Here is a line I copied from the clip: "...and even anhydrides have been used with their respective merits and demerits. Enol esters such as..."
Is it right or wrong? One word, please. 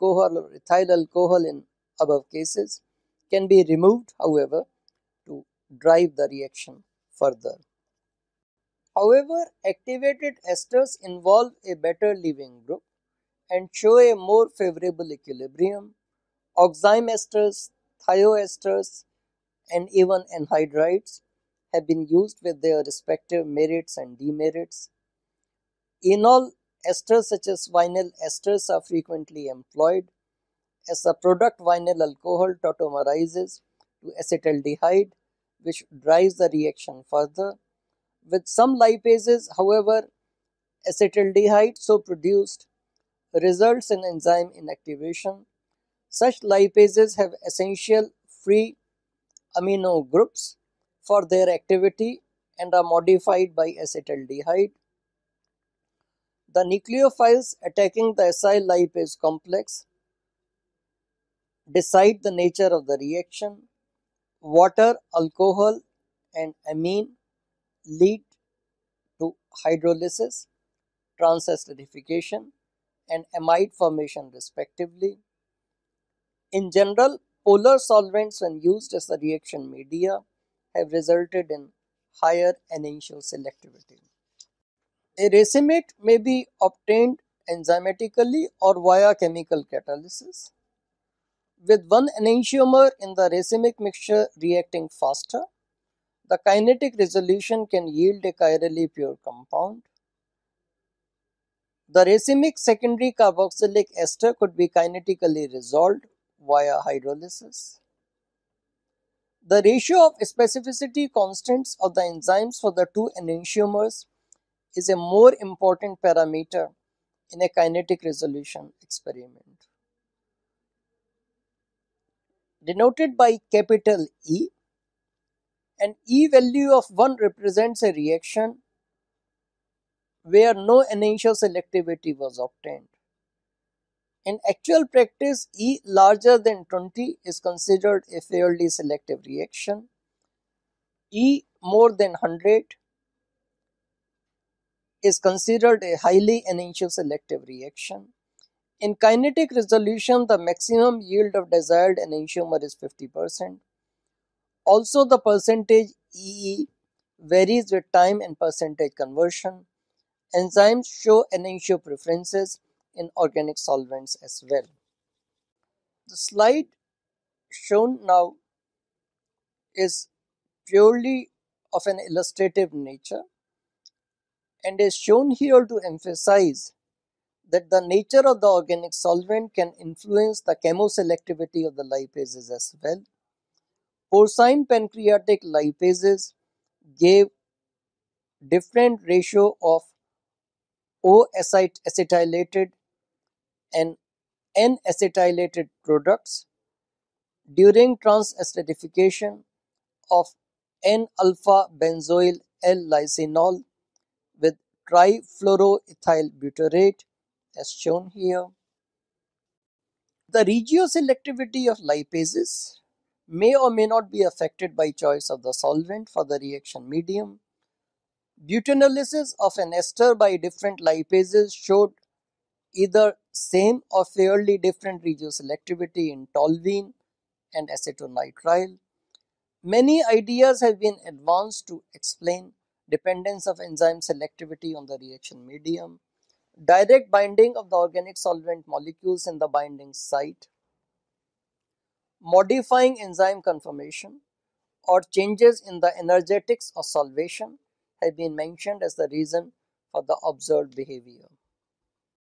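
right.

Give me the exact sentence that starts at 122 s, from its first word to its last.
Denoted by capital E, an E value of 1 represents a reaction where no initial selectivity was obtained.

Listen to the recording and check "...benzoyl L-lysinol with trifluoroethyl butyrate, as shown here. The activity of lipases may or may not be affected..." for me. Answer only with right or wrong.
wrong.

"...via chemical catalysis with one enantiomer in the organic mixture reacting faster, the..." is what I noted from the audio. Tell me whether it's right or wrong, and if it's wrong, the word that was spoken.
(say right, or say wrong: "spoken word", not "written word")
wrong: "racemic", not "organic".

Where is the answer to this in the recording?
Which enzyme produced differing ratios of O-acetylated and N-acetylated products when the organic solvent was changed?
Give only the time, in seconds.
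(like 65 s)
184 s.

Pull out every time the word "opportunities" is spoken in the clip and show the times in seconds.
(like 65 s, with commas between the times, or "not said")
not said.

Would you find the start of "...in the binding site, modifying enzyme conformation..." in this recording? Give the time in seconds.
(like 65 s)
239 s.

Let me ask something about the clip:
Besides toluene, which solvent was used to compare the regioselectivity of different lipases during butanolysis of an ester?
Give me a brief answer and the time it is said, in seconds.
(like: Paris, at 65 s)
acetonitrile, at 227 s.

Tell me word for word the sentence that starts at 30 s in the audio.
As a product, vinyl alcohol tautomerizes to acetaldehyde, which drives the reaction further.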